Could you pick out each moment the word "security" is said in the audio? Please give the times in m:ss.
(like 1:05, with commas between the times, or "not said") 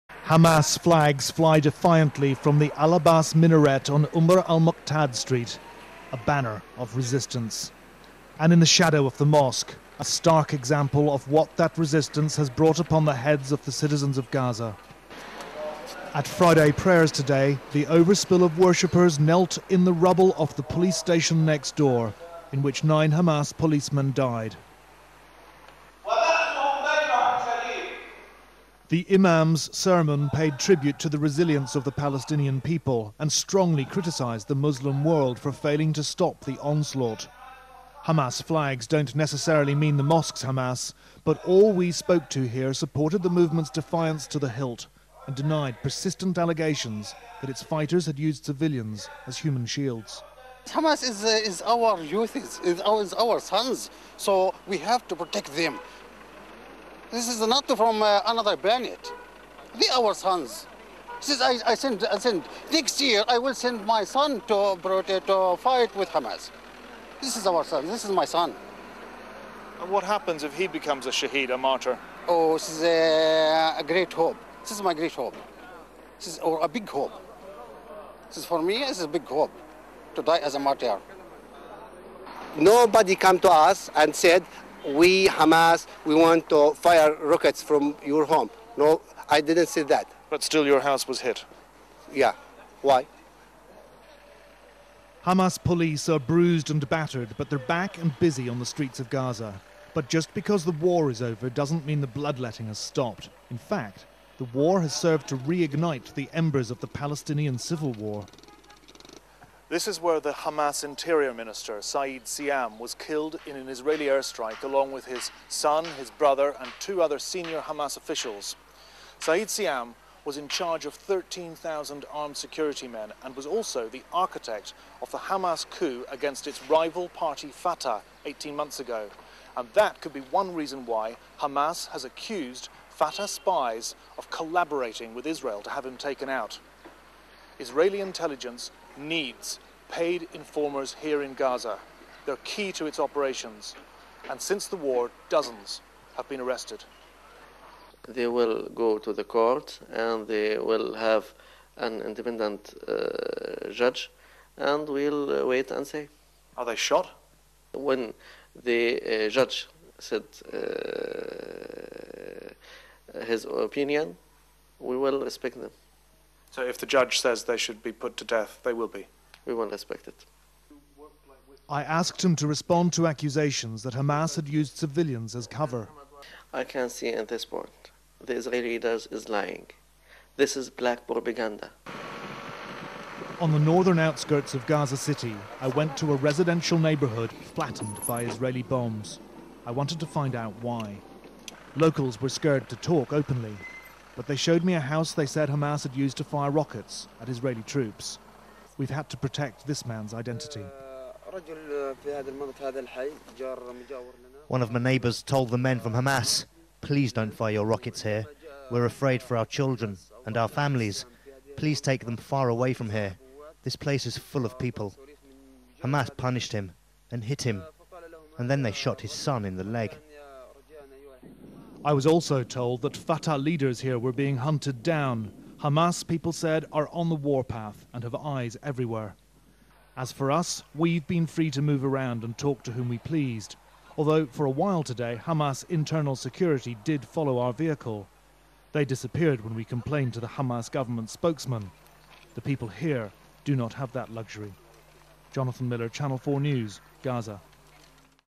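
2:02, 3:56.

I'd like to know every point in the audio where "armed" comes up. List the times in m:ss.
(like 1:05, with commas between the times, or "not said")
2:02.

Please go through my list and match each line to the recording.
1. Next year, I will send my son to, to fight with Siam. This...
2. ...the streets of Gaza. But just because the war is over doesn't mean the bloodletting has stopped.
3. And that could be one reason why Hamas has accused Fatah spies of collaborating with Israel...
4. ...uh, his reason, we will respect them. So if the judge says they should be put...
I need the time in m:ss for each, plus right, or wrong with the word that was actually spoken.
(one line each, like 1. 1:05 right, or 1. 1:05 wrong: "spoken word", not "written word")
1. 1:02 wrong: "Hamas", not "Siam"
2. 1:38 right
3. 2:09 right
4. 2:40 wrong: "opinion", not "reason".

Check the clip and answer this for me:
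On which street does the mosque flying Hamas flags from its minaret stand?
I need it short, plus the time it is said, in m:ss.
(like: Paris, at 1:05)
Umar al Mukhtar Street, at 0:04.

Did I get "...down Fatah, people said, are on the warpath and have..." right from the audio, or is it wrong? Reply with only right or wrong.
wrong.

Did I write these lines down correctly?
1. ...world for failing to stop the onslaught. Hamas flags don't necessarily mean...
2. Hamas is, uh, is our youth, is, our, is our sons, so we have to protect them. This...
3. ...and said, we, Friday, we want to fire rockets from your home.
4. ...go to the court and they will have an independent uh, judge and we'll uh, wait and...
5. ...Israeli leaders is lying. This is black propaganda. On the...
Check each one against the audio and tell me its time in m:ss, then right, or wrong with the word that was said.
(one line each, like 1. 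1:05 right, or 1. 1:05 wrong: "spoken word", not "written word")
1. 0:35 right
2. 0:50 right
3. 1:23 wrong: "Hamas", not "Friday"
4. 2:28 right
5. 2:58 right.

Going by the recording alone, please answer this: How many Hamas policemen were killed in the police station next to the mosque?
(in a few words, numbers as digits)
9.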